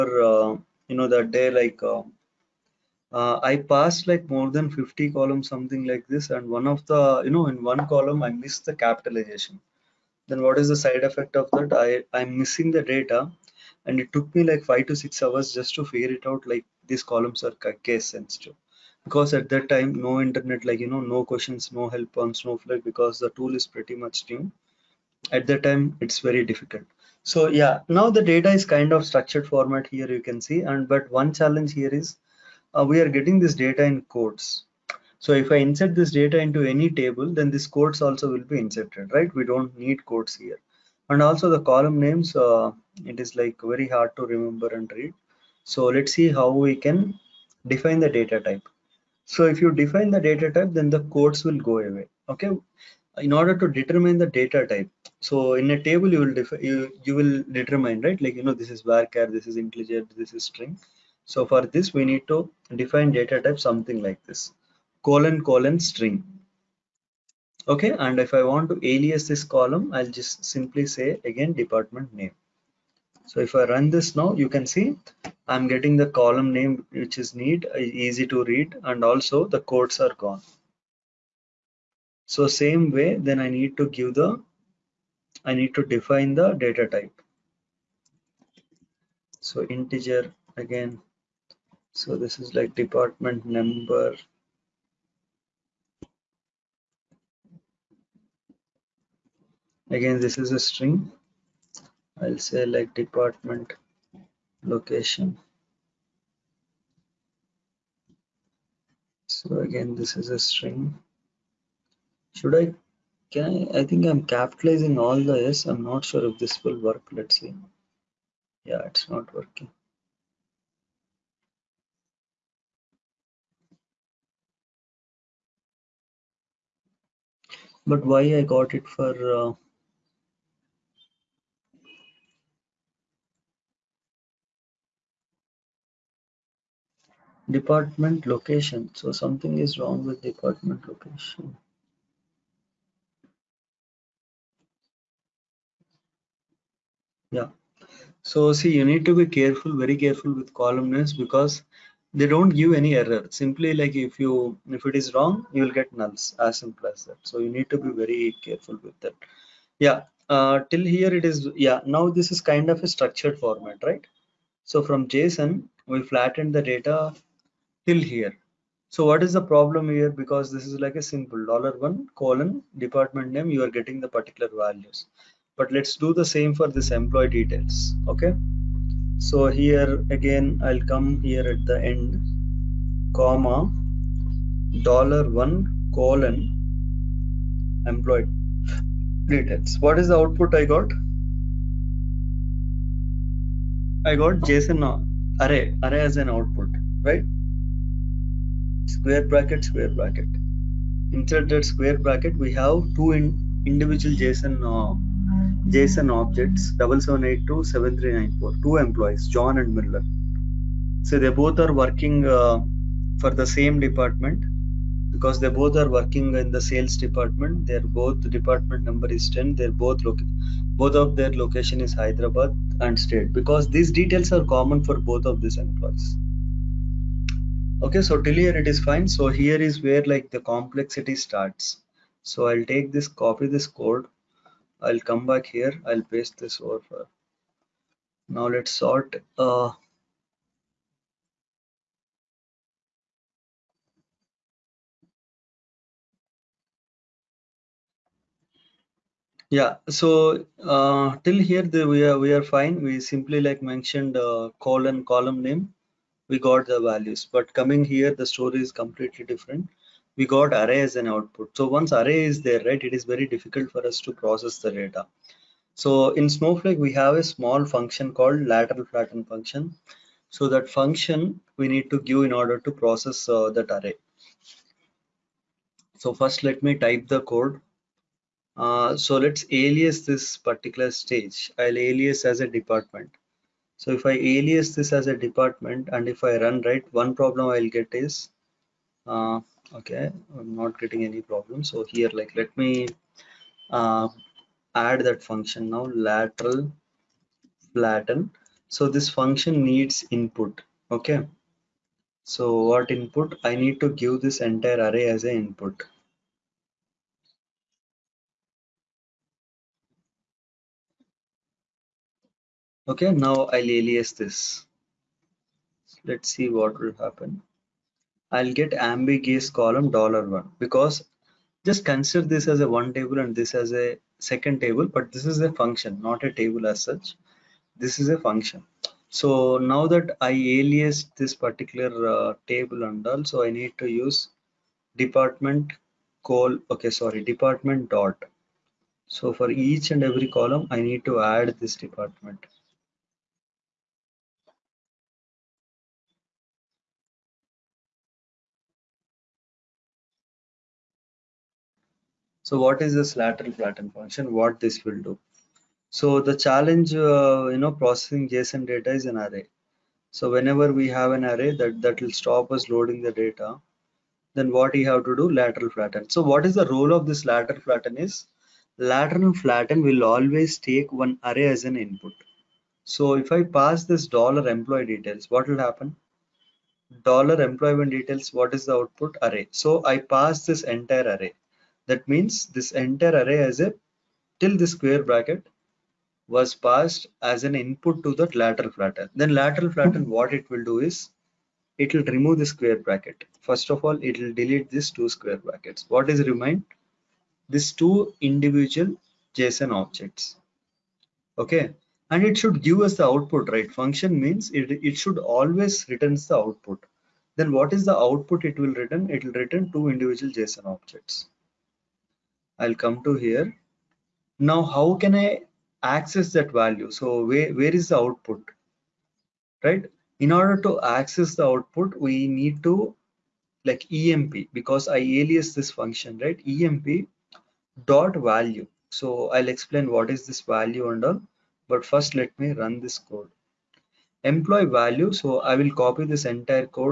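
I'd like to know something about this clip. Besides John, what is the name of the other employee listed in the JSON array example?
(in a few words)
Miller.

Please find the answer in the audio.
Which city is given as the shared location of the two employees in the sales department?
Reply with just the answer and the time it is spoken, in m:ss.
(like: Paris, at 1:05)
Hyderabad, at 3:41.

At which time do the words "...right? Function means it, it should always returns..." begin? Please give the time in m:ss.
6:43.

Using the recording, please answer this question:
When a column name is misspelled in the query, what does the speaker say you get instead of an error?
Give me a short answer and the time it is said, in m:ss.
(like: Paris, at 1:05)
nulls, at 2:36.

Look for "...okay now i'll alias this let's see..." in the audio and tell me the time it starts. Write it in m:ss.
5:12.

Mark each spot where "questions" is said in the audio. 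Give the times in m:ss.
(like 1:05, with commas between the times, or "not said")
0:21.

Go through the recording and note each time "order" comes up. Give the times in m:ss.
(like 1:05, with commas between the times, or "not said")
0:53, 4:32, 7:00.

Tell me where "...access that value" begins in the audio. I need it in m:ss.
6:55.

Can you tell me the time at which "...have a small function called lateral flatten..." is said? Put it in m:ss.
4:26.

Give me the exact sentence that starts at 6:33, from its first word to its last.
First of all, it will delete these two square brackets.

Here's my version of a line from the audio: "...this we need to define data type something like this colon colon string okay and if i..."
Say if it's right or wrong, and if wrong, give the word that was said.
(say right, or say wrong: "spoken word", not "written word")
right.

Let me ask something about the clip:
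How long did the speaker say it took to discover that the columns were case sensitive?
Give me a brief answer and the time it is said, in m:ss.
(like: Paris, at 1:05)
5 to 6 hours, at 0:14.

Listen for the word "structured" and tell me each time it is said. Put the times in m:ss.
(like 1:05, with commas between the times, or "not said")
0:29, 2:42.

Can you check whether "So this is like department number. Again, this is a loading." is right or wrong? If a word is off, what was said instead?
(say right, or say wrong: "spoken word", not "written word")
wrong: "string", not "loading".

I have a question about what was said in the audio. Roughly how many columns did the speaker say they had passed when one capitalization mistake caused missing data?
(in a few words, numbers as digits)
more than 50.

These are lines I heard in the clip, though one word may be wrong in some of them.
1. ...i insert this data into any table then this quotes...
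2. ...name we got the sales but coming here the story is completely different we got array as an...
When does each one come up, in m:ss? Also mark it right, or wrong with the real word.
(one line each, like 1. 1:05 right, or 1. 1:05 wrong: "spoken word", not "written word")
1. 0:35 right
2. 4:15 wrong: "values", not "sales".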